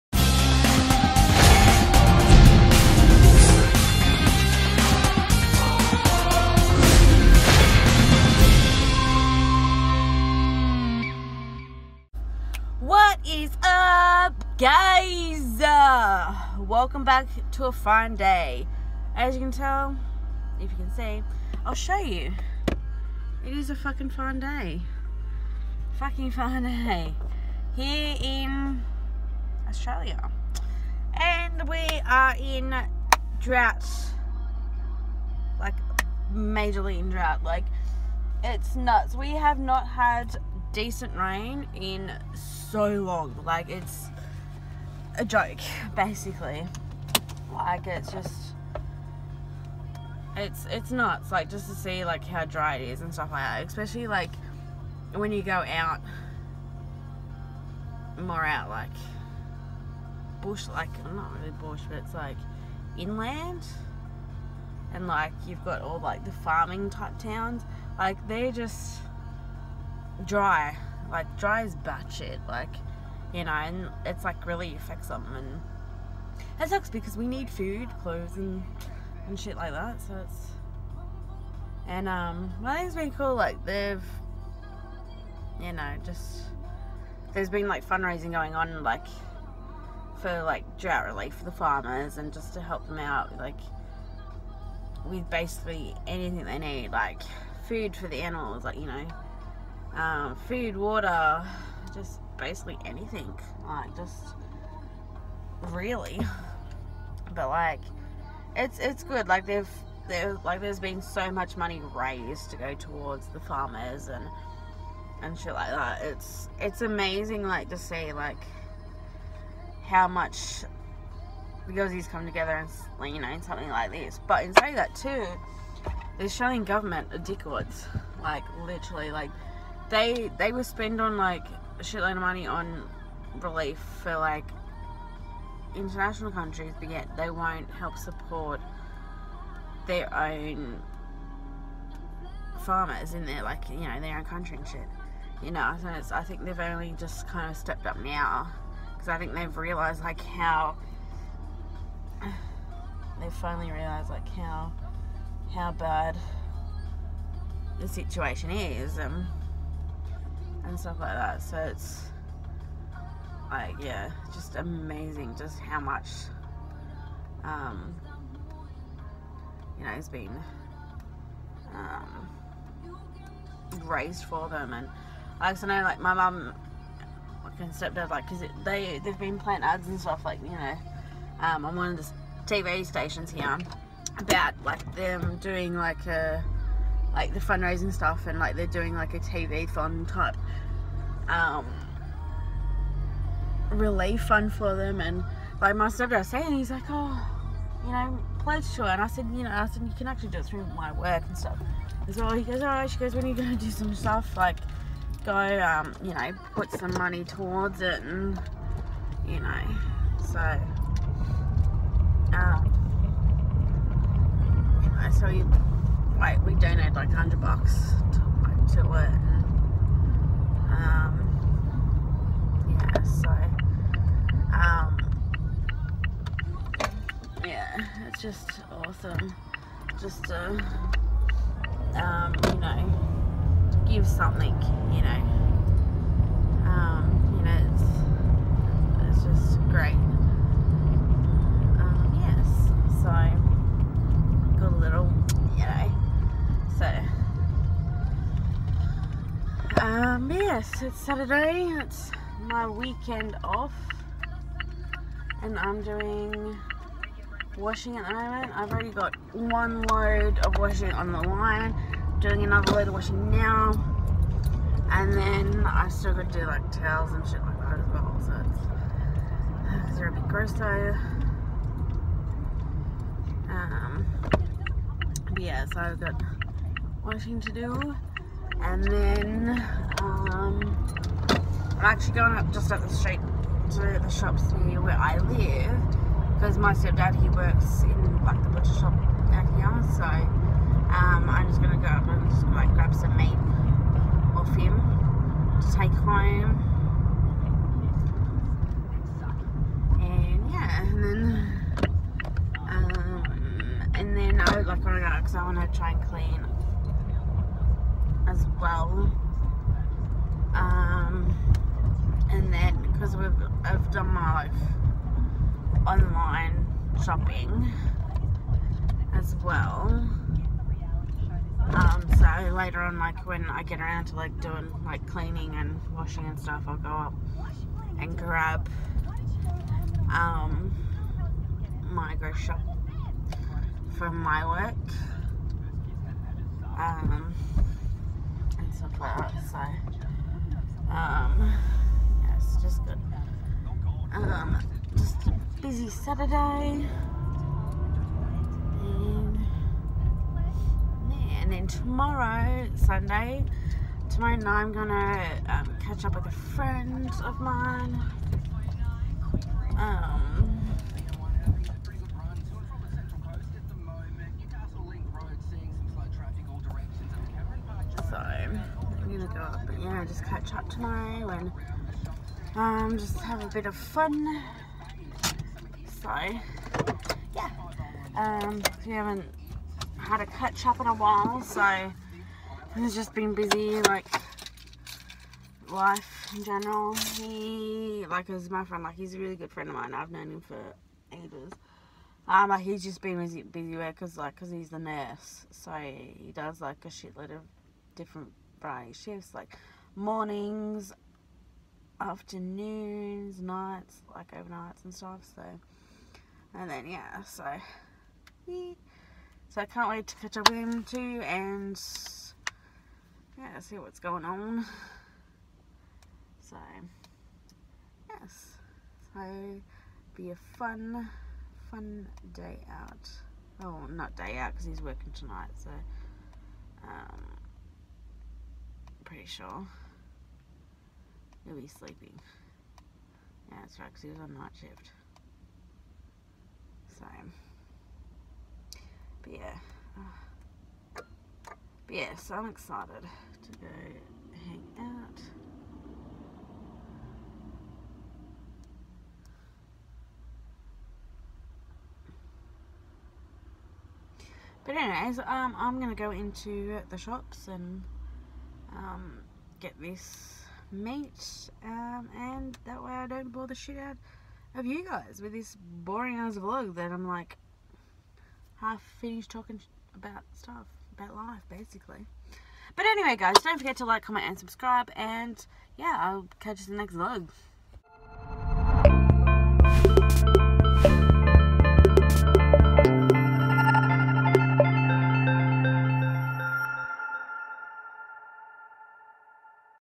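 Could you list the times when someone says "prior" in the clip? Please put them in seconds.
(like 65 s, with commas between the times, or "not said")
not said.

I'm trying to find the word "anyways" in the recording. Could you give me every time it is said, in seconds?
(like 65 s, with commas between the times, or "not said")
454 s, 472 s.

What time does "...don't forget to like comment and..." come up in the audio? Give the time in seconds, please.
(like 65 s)
473 s.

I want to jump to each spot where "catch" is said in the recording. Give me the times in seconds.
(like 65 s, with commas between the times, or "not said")
355 s, 370 s, 380 s, 410 s, 476 s.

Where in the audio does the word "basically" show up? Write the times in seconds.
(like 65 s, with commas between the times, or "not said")
45 s, 95 s, 102 s, 471 s.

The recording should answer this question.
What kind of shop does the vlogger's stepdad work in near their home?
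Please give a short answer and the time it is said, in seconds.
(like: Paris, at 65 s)
Butcher shop, at 288 s.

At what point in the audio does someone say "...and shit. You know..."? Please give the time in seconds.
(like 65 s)
144 s.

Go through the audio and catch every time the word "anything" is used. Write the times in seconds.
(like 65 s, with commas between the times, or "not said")
96 s, 102 s.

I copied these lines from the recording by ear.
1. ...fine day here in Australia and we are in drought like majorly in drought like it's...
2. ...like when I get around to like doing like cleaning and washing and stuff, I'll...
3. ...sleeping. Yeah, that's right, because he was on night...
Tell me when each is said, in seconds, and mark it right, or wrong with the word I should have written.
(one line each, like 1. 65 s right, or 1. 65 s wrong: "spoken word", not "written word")
1. 26 s right
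2. 322 s right
3. 431 s right.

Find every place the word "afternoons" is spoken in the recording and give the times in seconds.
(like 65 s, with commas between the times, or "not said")
401 s.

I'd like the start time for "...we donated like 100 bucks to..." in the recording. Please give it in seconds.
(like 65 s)
216 s.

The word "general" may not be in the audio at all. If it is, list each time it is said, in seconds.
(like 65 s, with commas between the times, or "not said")
386 s.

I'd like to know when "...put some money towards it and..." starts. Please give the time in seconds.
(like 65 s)
206 s.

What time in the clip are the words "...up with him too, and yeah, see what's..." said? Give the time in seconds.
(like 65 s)
410 s.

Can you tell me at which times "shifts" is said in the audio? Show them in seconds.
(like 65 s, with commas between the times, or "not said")
398 s, 434 s.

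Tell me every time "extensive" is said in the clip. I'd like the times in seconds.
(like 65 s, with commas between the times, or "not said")
not said.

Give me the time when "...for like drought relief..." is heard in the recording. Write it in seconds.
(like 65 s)
90 s.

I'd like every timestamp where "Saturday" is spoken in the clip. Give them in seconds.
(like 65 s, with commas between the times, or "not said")
250 s, 345 s.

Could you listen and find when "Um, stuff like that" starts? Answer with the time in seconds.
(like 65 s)
336 s.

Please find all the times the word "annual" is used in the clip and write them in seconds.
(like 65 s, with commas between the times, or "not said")
not said.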